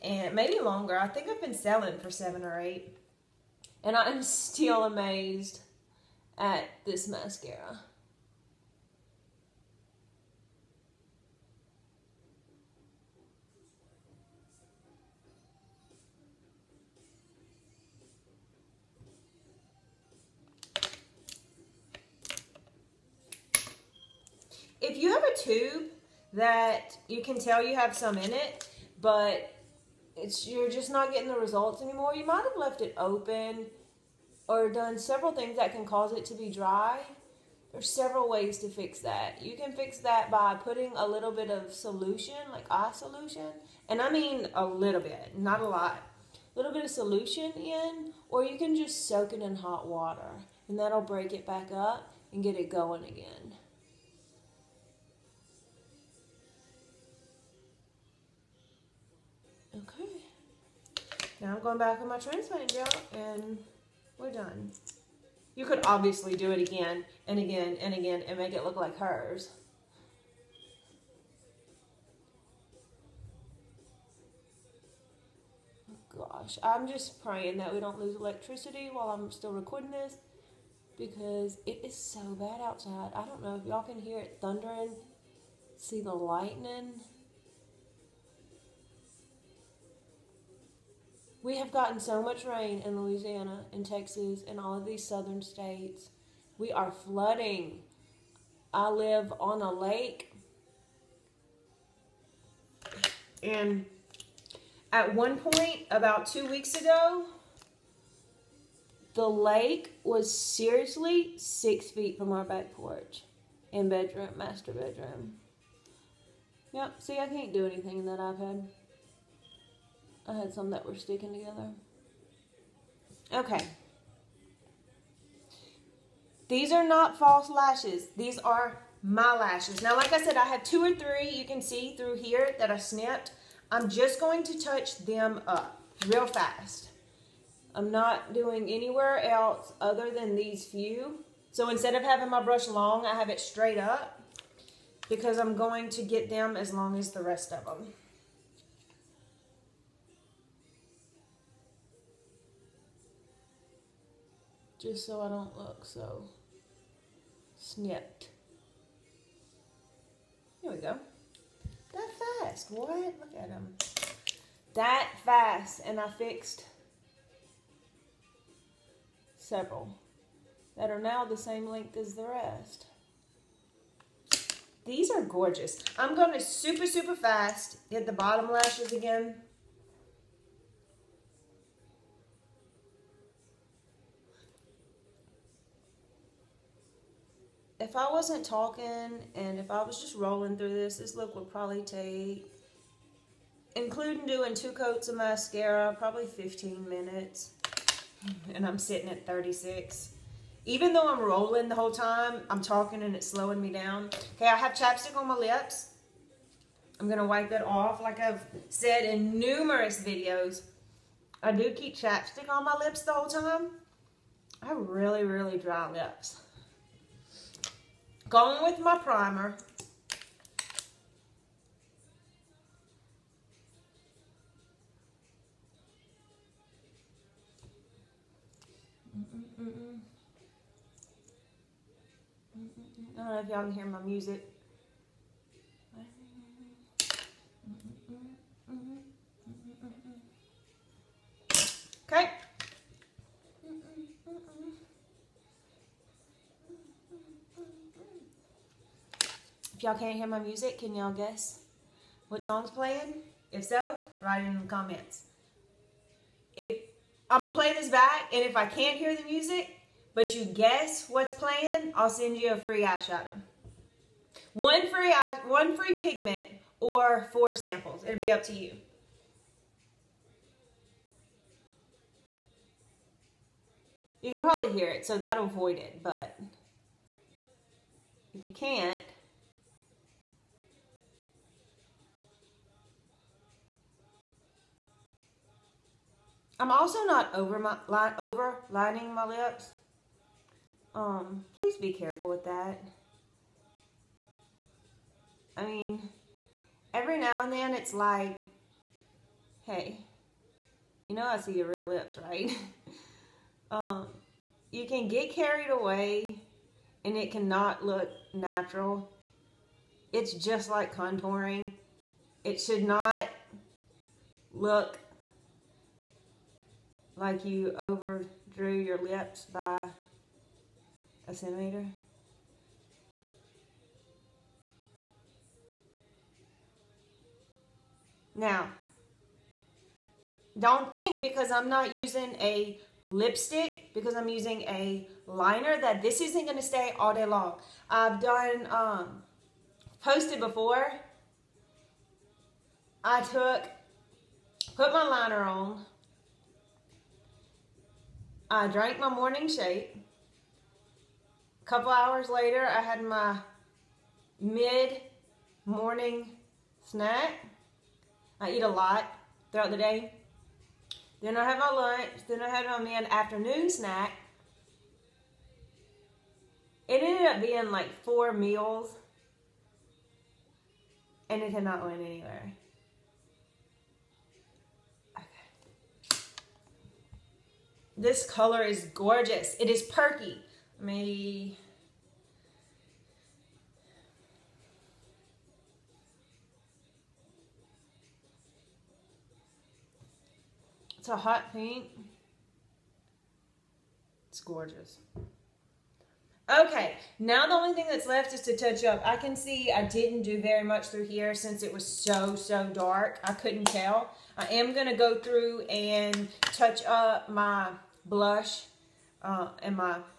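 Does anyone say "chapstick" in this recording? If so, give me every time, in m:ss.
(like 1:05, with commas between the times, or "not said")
3:24, 3:31.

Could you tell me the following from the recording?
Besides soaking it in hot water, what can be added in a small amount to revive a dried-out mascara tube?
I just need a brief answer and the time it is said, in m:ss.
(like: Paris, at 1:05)
eye solution, at 0:42.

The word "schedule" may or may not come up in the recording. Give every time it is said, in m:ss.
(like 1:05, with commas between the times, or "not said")
not said.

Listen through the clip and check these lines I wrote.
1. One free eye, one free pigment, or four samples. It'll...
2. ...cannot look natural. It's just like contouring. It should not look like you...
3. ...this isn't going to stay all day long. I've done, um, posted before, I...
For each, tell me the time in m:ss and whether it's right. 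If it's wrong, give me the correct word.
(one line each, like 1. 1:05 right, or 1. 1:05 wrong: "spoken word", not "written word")
1. 4:24 right
2. 5:07 right
3. 5:36 right.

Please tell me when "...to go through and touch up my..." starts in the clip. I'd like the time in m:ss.
6:44.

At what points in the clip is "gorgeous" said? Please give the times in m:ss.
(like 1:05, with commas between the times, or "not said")
2:55, 6:18, 6:34.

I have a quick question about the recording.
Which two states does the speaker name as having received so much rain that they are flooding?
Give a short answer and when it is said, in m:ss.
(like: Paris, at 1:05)
Louisiana and Texas, at 1:33.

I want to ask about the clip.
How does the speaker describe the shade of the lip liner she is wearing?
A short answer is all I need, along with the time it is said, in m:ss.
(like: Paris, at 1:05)
hot pink, at 6:31.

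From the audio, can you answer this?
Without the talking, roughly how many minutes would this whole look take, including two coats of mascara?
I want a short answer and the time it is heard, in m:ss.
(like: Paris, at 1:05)
15 minutes, at 3:16.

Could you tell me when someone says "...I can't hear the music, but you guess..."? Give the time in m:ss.
4:18.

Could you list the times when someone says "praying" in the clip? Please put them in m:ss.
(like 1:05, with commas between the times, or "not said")
1:17.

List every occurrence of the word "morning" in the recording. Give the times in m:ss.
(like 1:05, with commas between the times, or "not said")
5:49, 5:55.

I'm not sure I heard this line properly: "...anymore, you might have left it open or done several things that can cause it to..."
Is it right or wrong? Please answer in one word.
right.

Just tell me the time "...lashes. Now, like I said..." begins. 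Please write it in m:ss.
2:09.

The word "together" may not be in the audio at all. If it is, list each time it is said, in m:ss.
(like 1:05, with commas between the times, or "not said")
2:01.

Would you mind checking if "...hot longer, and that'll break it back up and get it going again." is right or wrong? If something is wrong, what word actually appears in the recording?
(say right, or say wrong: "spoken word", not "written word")
wrong: "water", not "longer".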